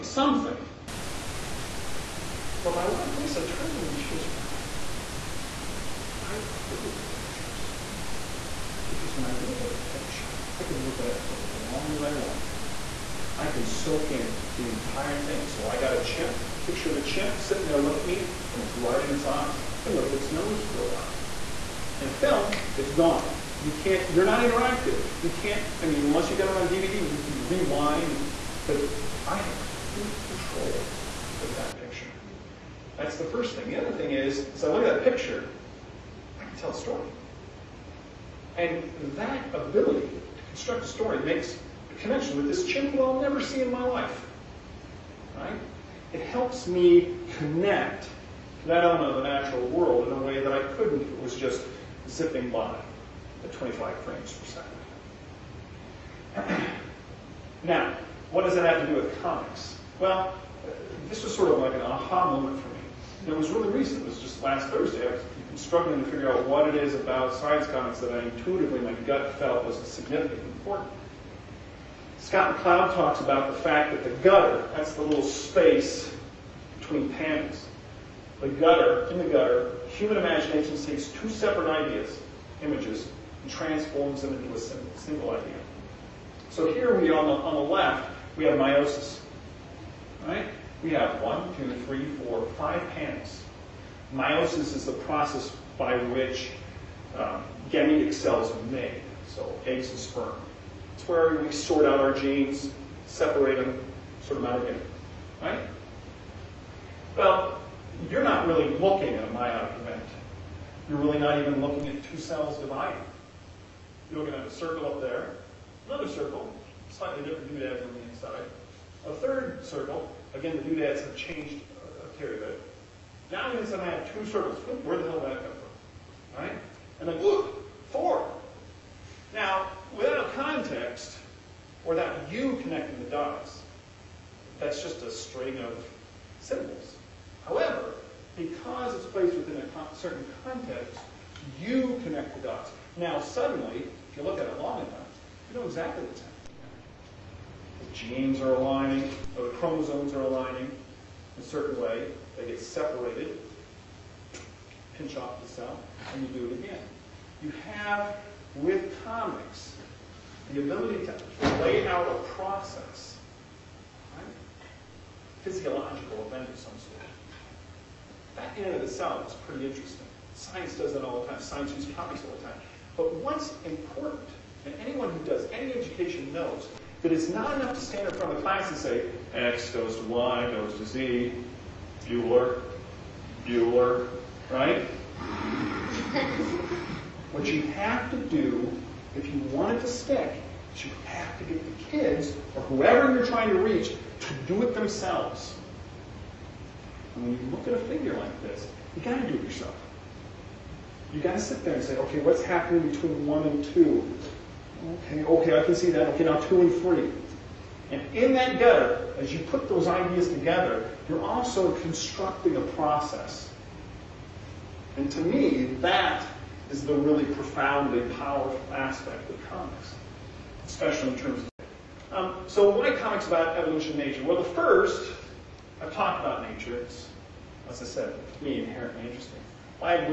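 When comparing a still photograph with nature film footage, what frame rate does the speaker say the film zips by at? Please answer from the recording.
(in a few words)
25 frames per second.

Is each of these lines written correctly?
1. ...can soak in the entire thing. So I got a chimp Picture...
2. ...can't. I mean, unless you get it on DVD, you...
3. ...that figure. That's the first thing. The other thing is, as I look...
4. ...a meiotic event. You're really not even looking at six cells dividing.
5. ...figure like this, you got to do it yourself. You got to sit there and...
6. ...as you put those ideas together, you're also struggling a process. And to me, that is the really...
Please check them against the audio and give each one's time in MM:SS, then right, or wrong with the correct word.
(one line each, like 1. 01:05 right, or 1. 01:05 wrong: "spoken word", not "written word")
1. 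00:13 right
2. 00:25 right
3. 00:31 wrong: "picture", not "figure"
4. 01:49 wrong: "two", not "six"
5. 03:17 right
6. 03:29 wrong: "constructing", not "struggling".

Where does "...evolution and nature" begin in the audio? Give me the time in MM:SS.
03:43.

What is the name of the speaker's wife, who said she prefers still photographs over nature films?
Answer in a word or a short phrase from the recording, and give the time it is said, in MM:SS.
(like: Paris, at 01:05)
Lisa, at 00:03.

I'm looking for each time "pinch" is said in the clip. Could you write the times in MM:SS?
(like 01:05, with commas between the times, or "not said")
02:34.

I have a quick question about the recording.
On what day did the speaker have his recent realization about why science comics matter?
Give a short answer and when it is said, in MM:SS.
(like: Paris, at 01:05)
Last Thursday, at 01:04.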